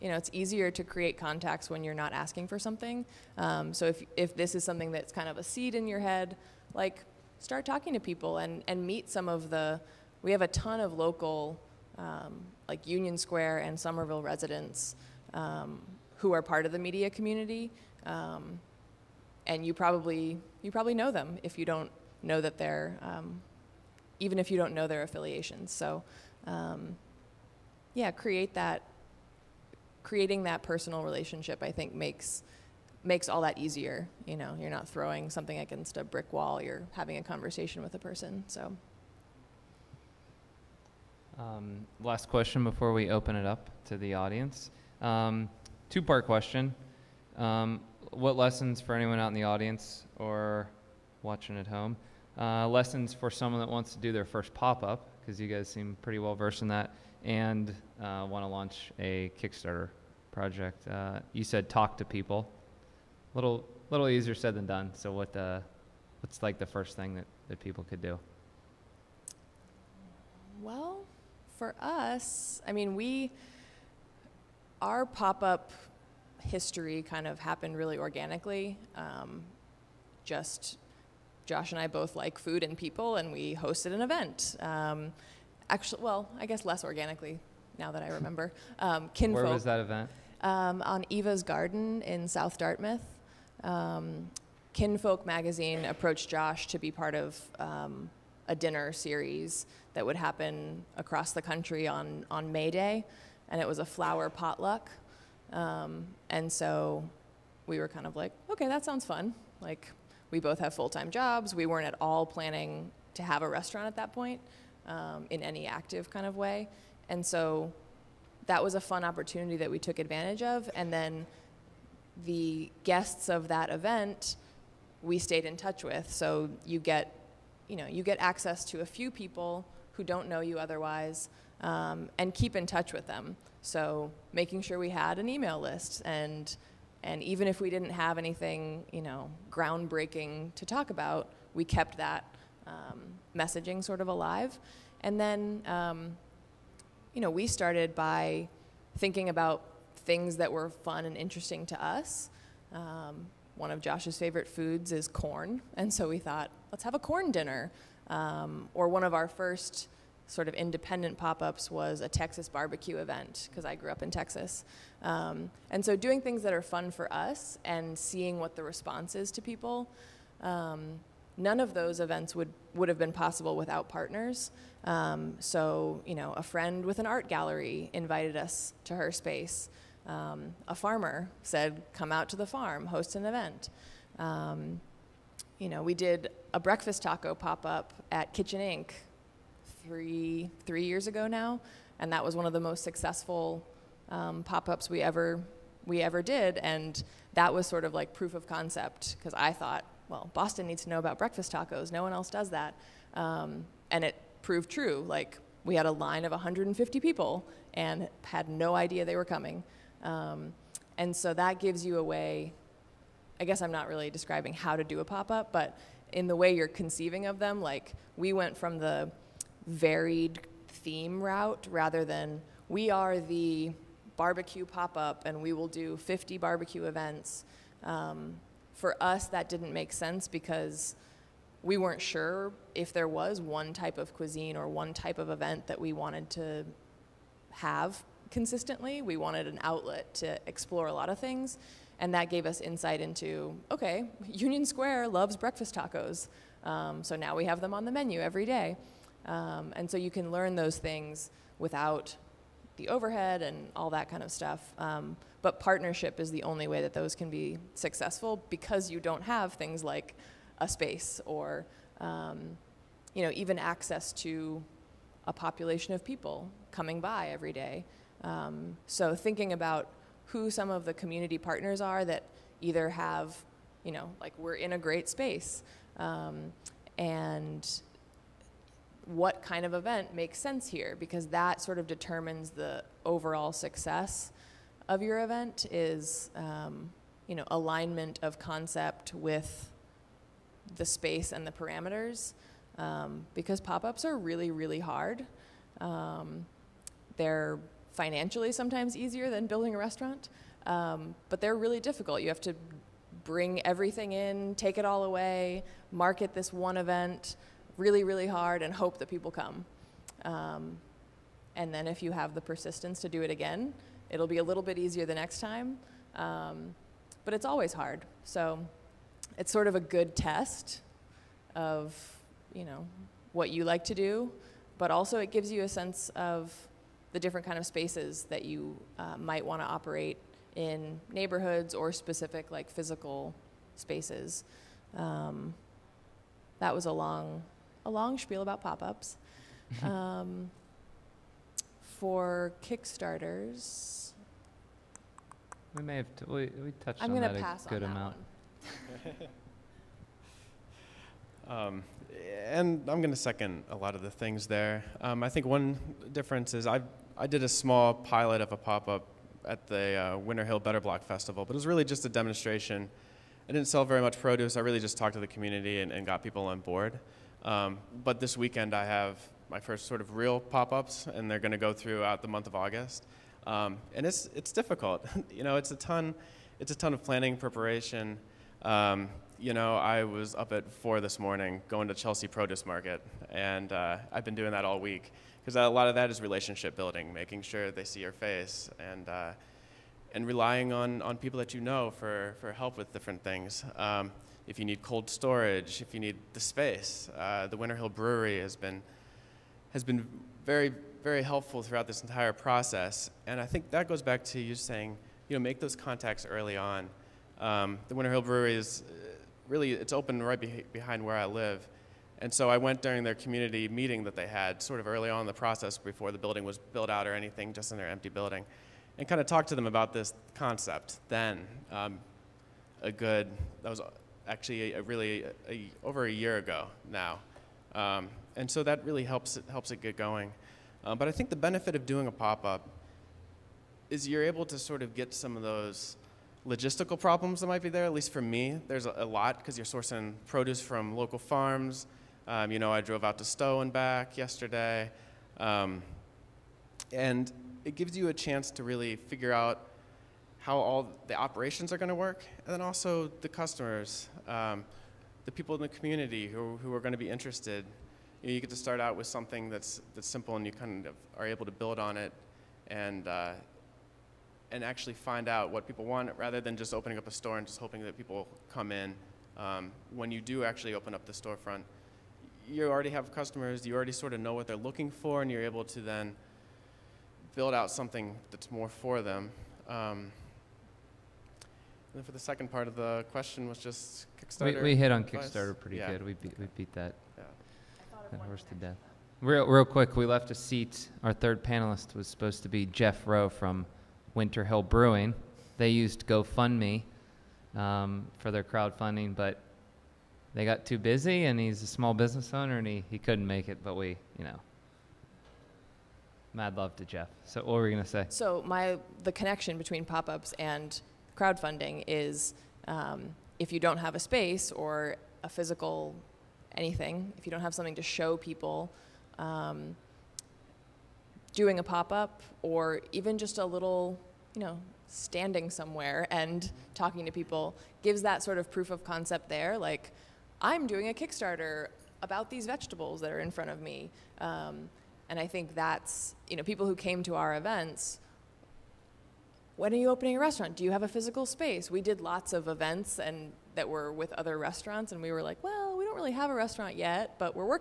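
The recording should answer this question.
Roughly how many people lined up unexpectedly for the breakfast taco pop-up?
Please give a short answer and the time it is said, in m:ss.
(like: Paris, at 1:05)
150, at 3:26.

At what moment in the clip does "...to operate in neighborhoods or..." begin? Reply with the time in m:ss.
5:29.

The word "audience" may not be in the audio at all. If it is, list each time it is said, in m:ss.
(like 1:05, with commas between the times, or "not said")
0:44, 0:49.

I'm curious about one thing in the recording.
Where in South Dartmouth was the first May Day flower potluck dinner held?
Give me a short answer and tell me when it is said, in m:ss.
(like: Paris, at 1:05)
Eva's Garden, at 1:31.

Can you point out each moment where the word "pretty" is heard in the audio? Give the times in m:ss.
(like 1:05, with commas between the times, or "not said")
0:56, 8:05.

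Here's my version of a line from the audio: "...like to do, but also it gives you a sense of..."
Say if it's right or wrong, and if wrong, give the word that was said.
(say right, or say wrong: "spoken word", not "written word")
right.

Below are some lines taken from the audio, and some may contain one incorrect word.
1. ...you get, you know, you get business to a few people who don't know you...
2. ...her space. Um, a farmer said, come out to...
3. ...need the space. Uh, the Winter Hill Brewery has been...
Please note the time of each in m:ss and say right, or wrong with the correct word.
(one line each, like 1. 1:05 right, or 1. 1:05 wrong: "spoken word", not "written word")
1. 2:06 wrong: "access", not "business"
2. 2:58 right
3. 6:35 right.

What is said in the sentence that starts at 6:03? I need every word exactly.
I didn't sell very much produce.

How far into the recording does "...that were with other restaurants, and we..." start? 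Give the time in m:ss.
9:03.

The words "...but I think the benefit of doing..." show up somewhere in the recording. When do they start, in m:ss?
7:10.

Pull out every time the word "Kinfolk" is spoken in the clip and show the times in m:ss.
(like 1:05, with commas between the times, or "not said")
1:29, 1:34.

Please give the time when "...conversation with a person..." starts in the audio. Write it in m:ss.
0:37.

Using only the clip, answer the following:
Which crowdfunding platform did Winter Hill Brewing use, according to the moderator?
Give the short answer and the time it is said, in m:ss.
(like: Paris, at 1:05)
GoFundMe, at 8:16.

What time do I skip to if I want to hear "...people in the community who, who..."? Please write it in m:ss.
7:35.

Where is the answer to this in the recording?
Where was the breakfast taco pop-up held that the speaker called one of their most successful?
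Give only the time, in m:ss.
3:08.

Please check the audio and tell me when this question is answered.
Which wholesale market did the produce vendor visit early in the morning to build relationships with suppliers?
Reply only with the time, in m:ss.
6:21.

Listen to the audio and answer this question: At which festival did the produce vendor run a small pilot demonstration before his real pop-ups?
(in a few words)
Winter Hill Better Block Festival.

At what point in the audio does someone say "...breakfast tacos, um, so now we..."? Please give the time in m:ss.
4:05.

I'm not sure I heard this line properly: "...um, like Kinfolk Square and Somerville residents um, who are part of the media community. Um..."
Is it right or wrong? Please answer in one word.
wrong.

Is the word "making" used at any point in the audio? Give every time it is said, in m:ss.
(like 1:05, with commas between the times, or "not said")
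2:14, 6:27.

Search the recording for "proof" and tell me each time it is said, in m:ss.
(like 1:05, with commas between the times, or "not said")
3:18, 8:48.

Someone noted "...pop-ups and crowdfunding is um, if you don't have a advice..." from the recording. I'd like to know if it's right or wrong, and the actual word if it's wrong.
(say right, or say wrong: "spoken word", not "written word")
wrong: "space", not "advice".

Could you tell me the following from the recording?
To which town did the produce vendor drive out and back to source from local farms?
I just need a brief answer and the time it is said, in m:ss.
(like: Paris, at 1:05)
Stow, at 7:23.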